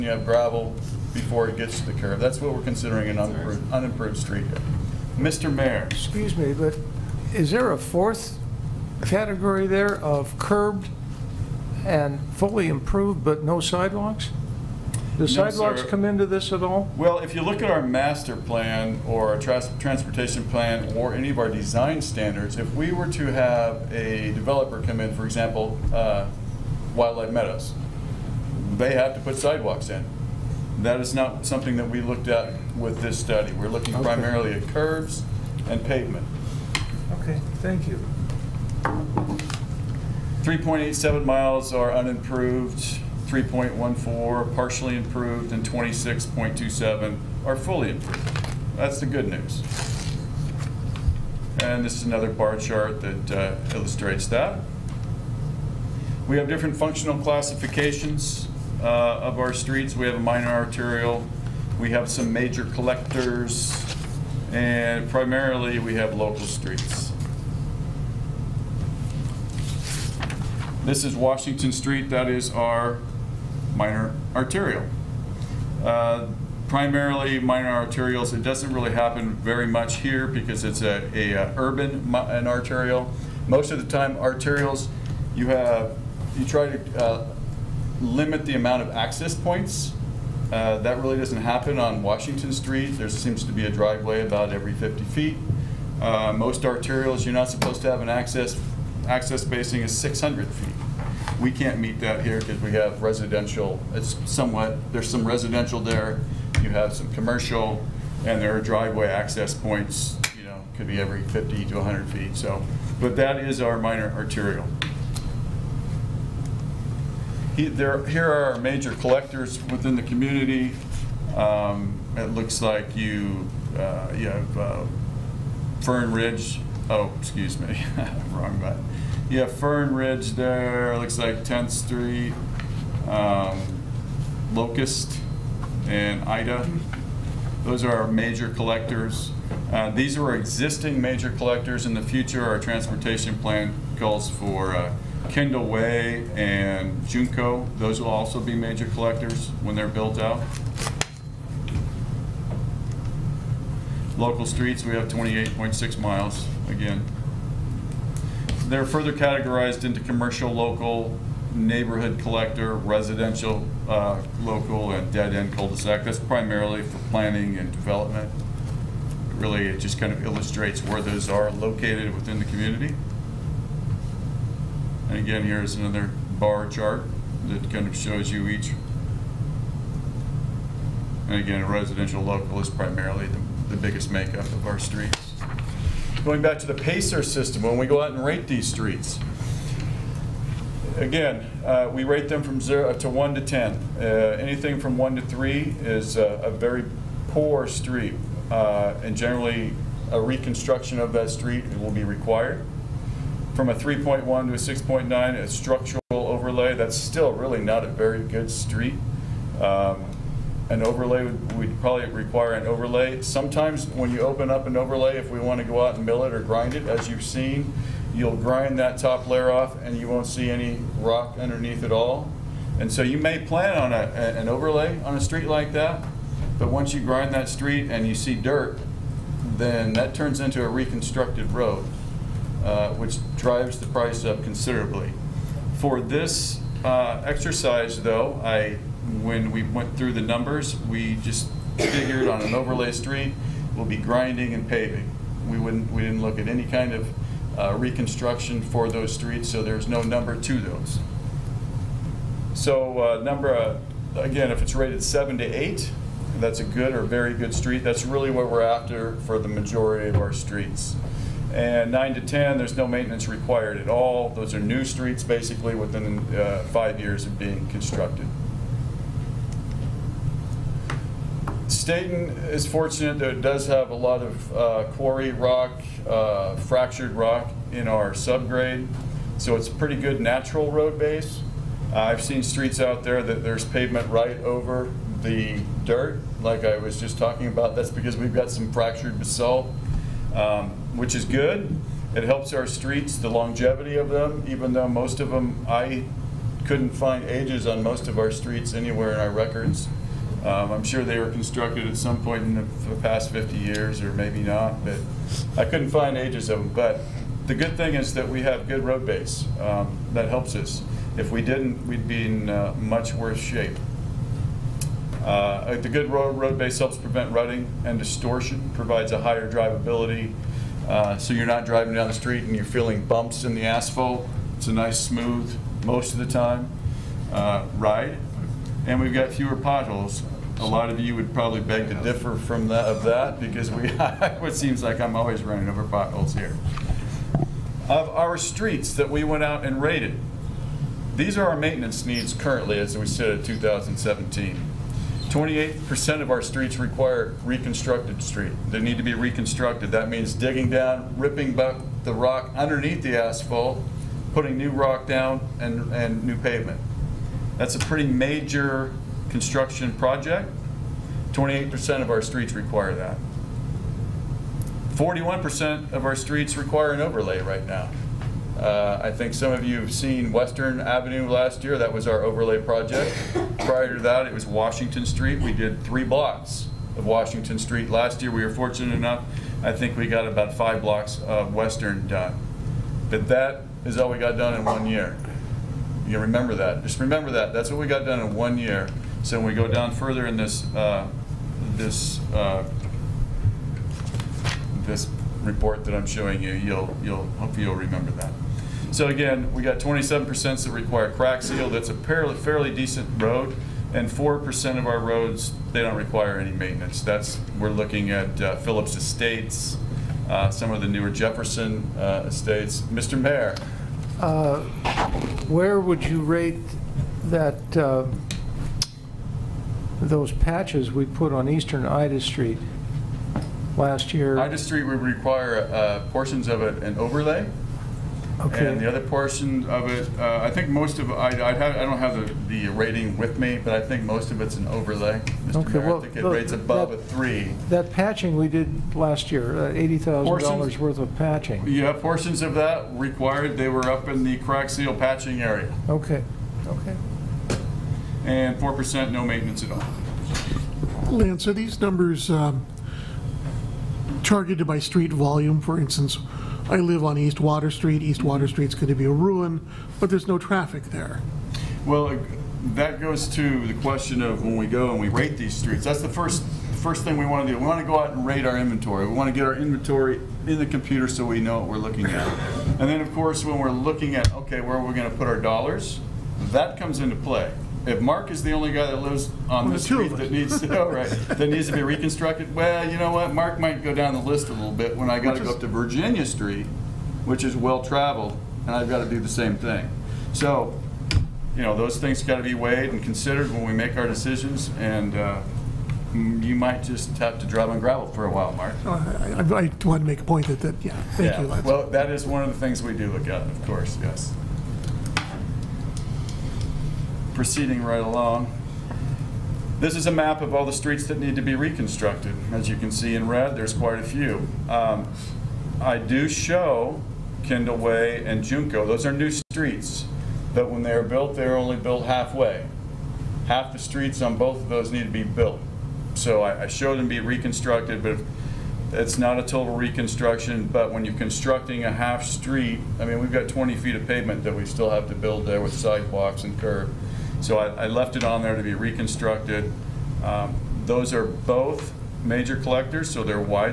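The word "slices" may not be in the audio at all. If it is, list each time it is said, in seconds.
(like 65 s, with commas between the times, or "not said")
not said.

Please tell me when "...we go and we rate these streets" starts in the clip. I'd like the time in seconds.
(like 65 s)
464 s.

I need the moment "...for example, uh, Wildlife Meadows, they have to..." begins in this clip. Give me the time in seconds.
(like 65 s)
25 s.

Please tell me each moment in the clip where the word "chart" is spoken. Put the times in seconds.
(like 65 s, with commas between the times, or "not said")
52 s, 176 s.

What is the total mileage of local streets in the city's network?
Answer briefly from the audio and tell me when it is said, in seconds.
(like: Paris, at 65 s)
28.6 miles, at 155 s.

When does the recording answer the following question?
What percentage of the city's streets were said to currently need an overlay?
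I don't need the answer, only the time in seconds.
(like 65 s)
364 s.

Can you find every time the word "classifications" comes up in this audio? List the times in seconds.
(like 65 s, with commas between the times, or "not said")
57 s.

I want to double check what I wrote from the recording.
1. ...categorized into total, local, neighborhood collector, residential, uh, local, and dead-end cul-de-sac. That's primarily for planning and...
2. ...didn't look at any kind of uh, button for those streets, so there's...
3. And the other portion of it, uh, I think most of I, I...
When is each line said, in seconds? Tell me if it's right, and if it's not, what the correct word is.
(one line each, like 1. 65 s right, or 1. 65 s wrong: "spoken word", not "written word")
1. 159 s wrong: "commercial", not "total"
2. 246 s wrong: "reconstruction", not "button"
3. 428 s right.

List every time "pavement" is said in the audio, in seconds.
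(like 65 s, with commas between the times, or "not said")
35 s, 283 s, 356 s, 534 s.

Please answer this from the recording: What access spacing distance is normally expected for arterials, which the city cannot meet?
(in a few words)
600 feet.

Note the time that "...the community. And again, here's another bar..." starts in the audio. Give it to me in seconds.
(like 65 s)
172 s.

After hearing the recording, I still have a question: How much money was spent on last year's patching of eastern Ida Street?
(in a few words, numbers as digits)
$80,000.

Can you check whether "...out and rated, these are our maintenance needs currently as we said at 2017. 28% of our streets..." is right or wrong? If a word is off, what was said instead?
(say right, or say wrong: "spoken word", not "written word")
right.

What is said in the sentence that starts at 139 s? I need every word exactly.
Uh, these are existing major collectors.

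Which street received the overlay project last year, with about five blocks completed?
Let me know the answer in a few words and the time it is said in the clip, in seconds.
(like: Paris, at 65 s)
Western Avenue, at 370 s.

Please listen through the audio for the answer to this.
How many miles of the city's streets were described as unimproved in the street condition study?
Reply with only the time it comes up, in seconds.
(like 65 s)
40 s.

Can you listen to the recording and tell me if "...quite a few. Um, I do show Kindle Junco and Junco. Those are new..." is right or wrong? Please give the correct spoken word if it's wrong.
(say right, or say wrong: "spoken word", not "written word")
wrong: "Way", not "Junco".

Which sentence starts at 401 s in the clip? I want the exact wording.
That's a fairly fairly decent road, and 4% of our roads they don't require any maintenance.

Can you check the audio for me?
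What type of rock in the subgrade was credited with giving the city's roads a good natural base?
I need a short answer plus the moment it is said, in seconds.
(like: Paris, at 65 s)
fractured basalt, at 288 s.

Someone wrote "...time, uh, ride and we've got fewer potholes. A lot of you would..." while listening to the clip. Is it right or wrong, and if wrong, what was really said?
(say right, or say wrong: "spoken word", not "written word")
right.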